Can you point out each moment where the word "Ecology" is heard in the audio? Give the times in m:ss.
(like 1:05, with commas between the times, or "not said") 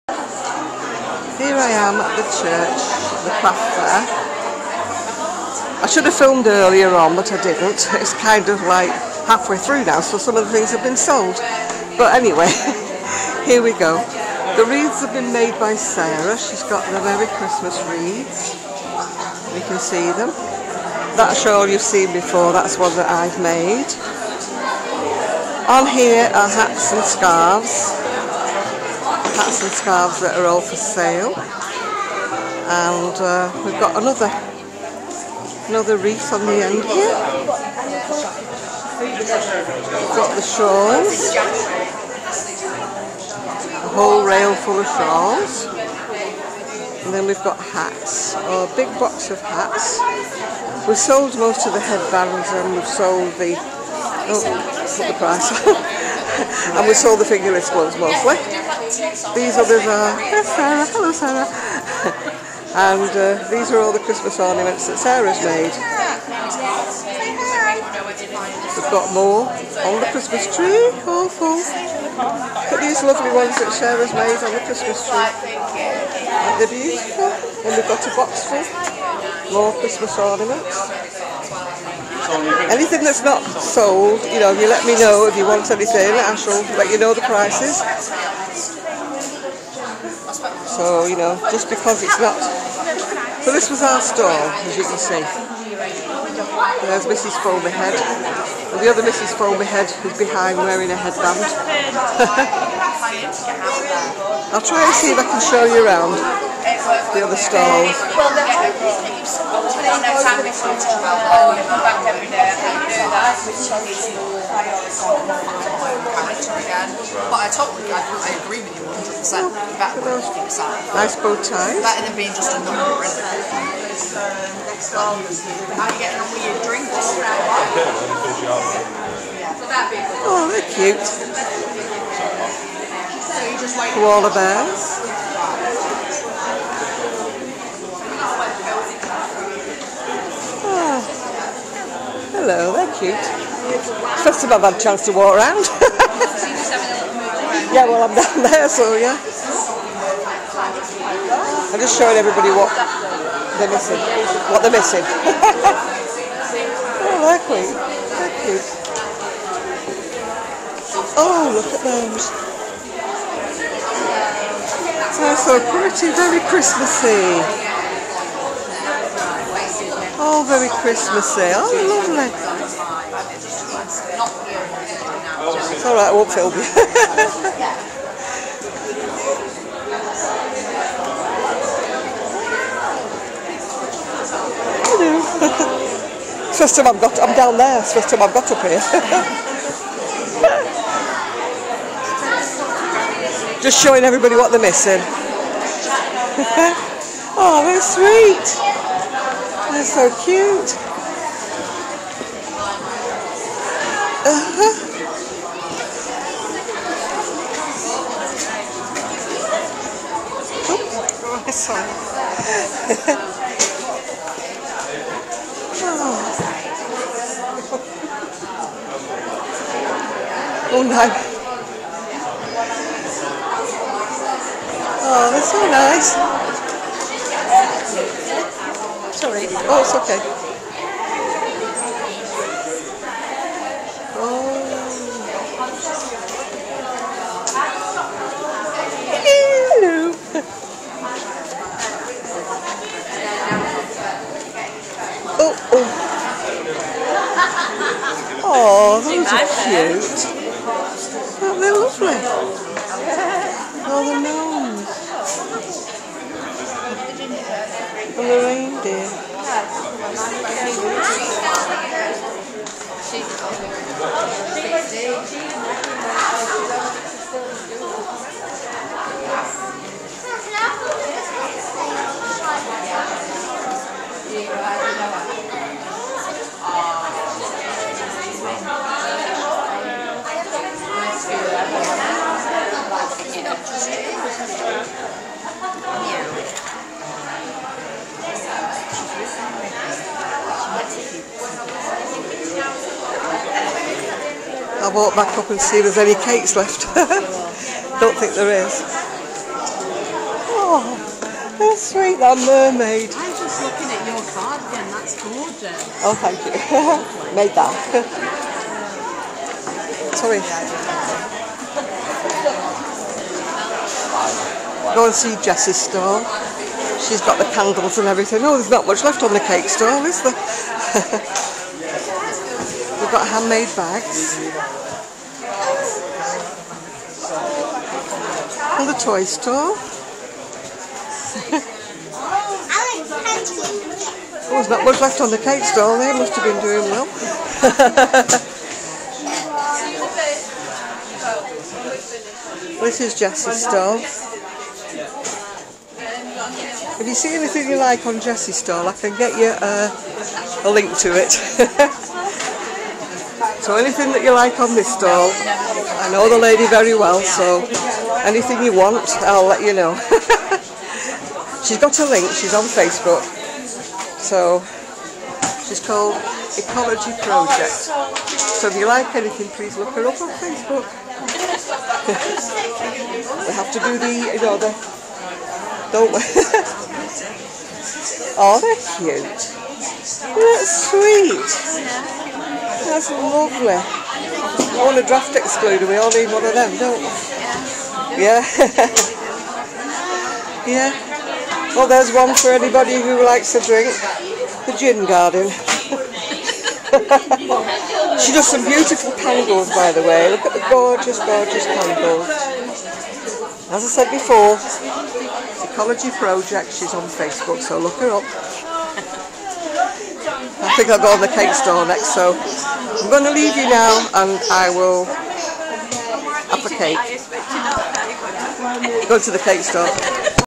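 6:06, 6:45.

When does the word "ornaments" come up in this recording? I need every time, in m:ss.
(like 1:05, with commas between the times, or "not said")
1:04, 1:20.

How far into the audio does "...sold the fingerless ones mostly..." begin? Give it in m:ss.
0:56.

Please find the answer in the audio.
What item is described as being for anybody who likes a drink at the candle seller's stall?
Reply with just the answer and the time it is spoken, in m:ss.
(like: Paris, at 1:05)
The gin garden, at 6:34.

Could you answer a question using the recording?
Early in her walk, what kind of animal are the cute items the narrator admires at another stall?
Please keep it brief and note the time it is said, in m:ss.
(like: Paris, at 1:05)
Koala bears, at 2:13.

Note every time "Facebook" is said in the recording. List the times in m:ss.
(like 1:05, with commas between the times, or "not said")
6:02, 6:10, 6:47.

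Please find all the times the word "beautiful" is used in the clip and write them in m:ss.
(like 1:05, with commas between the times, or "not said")
1:16, 6:38.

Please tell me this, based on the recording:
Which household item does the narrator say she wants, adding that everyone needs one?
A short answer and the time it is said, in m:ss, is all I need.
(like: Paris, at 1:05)
draft excluder, at 6:25.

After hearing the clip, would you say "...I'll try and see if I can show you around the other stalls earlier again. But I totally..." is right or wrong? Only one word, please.
wrong.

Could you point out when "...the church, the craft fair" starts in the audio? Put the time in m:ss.
0:02.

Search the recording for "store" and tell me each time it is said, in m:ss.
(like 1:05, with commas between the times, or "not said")
5:29, 6:51, 6:59.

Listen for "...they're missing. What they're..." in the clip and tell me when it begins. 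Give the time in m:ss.
2:33.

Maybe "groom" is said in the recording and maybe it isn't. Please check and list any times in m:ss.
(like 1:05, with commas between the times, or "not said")
not said.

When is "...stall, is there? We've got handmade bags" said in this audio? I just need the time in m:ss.
5:19.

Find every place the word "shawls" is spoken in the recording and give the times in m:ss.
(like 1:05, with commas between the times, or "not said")
0:21, 0:40, 0:44.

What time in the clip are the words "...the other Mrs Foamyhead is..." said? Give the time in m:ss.
1:38.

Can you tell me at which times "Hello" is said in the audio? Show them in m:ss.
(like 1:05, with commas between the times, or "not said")
1:00, 2:22.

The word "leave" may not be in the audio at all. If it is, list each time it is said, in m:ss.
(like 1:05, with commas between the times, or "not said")
6:53.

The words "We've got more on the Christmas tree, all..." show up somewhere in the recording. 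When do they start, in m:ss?
1:08.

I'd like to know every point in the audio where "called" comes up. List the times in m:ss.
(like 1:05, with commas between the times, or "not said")
6:05.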